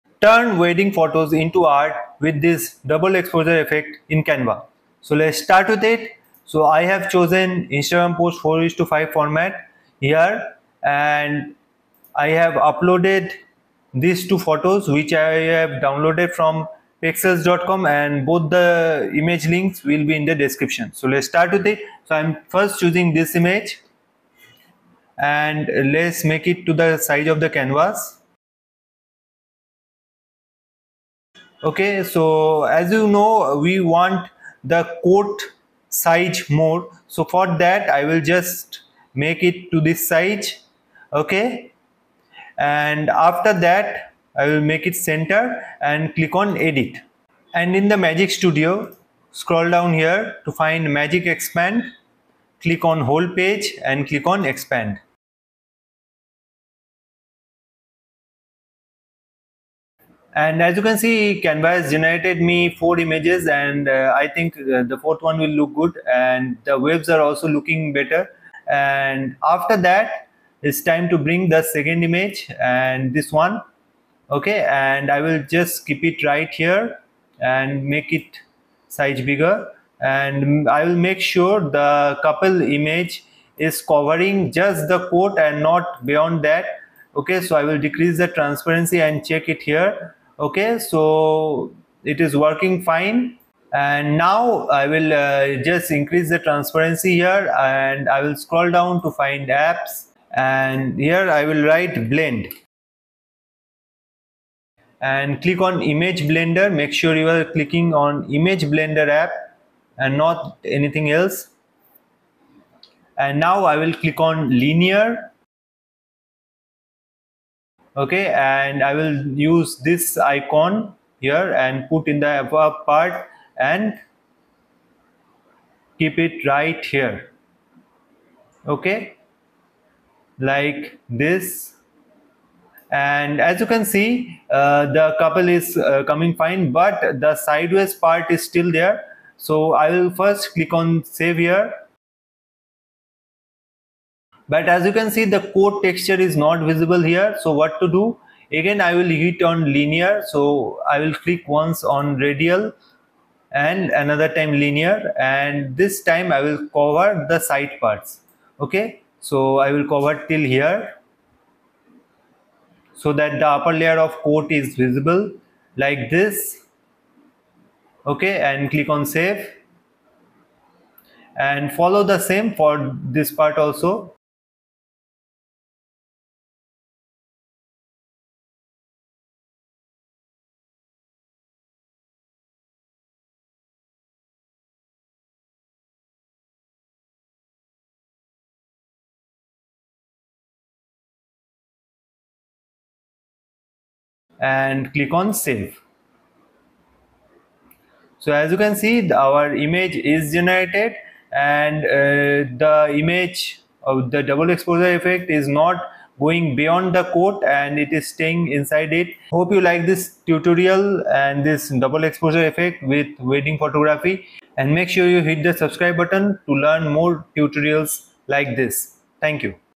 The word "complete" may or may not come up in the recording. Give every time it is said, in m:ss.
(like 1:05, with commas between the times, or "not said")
not said.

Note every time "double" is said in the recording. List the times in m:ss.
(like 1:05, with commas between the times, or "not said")
0:02, 3:24, 3:31.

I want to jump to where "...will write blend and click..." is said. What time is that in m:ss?
1:41.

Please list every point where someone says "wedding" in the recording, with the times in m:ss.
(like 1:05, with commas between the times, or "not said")
0:00, 3:33.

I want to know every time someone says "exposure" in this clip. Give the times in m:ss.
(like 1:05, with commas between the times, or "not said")
0:03, 3:24, 3:32.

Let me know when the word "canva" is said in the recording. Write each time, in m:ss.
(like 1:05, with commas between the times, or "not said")
0:04, 0:27, 1:01.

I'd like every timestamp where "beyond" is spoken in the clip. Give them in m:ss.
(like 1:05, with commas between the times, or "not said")
1:26, 3:26.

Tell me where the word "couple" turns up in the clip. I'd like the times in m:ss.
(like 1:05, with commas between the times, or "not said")
1:22, 2:15.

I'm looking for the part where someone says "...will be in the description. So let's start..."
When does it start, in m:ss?
0:19.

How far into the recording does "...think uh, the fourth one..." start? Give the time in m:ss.
1:04.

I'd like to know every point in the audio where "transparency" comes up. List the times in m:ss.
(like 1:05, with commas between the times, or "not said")
1:28, 1:36.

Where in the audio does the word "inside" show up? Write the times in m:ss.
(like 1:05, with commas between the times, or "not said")
3:28.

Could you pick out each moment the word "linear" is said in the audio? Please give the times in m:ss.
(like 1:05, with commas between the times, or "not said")
1:54, 2:29, 2:34.